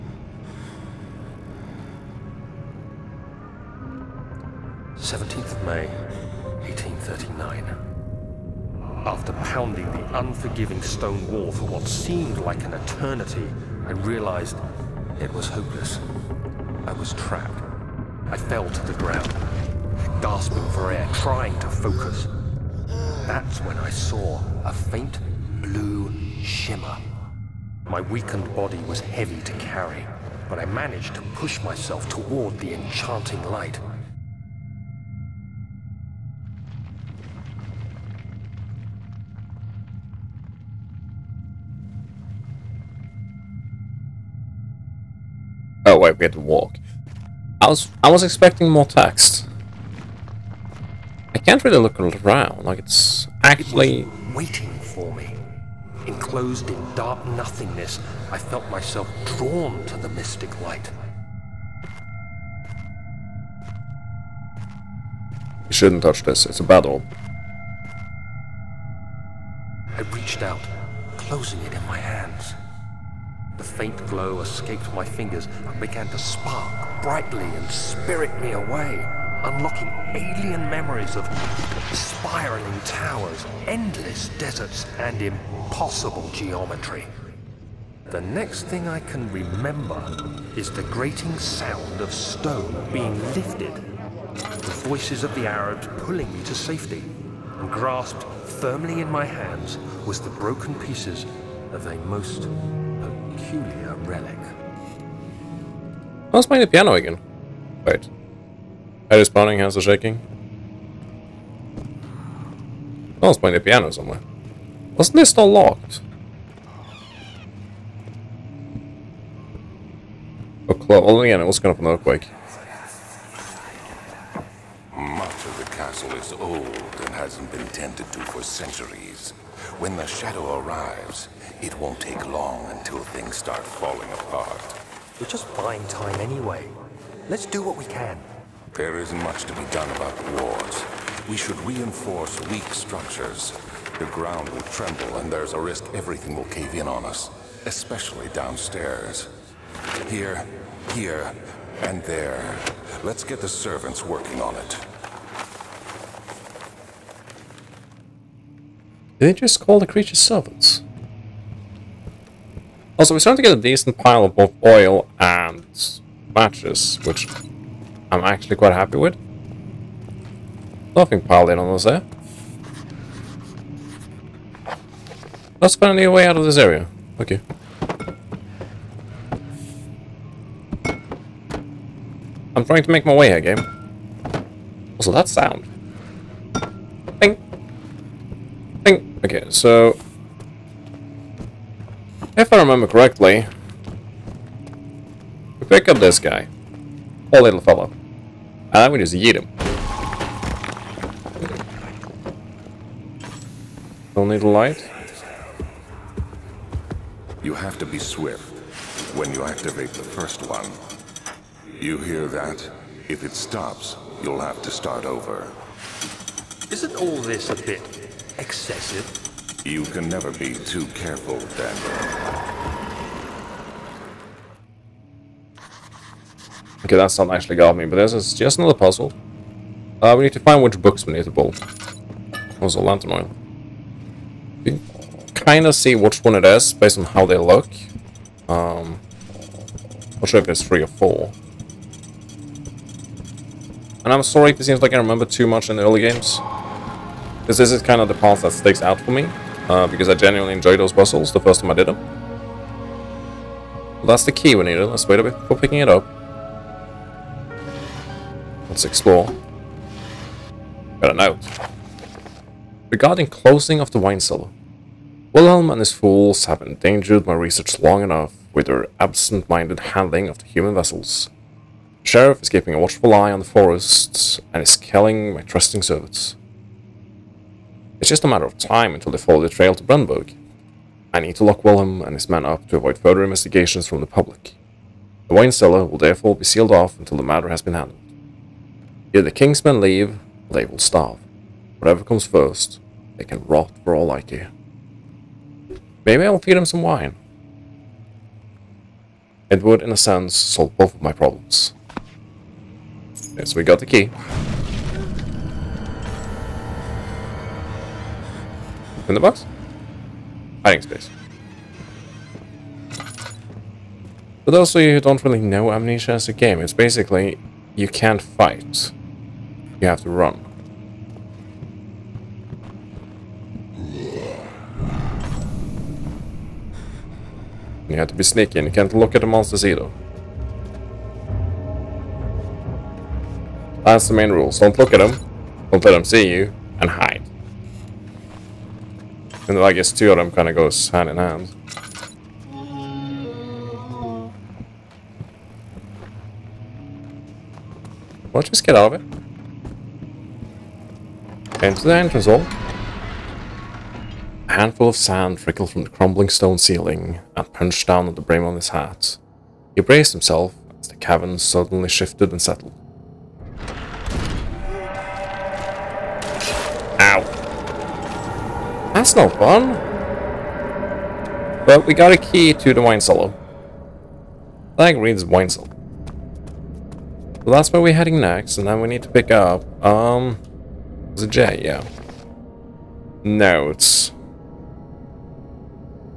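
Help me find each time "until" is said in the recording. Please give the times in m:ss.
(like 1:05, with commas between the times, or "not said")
2:12, 4:38, 4:46.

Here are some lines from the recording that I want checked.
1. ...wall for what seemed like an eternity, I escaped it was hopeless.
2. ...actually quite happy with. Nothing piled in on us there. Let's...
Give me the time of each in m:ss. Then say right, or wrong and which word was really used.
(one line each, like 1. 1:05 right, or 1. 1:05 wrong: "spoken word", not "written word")
1. 0:11 wrong: "realized", not "escaped"
2. 2:48 right.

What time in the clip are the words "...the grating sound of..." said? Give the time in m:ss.
1:30.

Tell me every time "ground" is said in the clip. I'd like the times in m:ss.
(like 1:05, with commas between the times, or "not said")
0:18, 2:24.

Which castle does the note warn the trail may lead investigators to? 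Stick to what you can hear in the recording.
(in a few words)
Brennenburg.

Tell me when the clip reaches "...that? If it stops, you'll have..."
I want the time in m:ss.
3:32.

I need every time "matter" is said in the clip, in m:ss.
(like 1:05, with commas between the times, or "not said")
4:38, 4:47.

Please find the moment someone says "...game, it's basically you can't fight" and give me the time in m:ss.
5:16.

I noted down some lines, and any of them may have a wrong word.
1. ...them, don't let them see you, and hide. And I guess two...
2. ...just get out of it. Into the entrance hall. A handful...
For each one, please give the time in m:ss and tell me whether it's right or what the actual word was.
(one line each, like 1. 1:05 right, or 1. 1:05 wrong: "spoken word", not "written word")
1. 5:34 right
2. 5:48 right.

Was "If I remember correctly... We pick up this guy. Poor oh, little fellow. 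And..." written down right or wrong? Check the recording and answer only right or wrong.
right.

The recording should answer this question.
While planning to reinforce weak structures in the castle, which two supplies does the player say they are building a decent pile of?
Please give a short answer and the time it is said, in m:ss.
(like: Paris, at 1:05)
oil and matches, at 2:44.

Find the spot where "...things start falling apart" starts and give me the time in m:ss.
2:12.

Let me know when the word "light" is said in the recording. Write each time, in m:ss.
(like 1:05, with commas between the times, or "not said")
0:33, 1:00, 3:24.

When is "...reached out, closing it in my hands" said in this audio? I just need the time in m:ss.
1:10.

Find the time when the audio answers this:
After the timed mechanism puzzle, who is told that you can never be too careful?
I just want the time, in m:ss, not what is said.
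3:41.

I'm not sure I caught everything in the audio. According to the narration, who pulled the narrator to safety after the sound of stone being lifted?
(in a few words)
the Arabs.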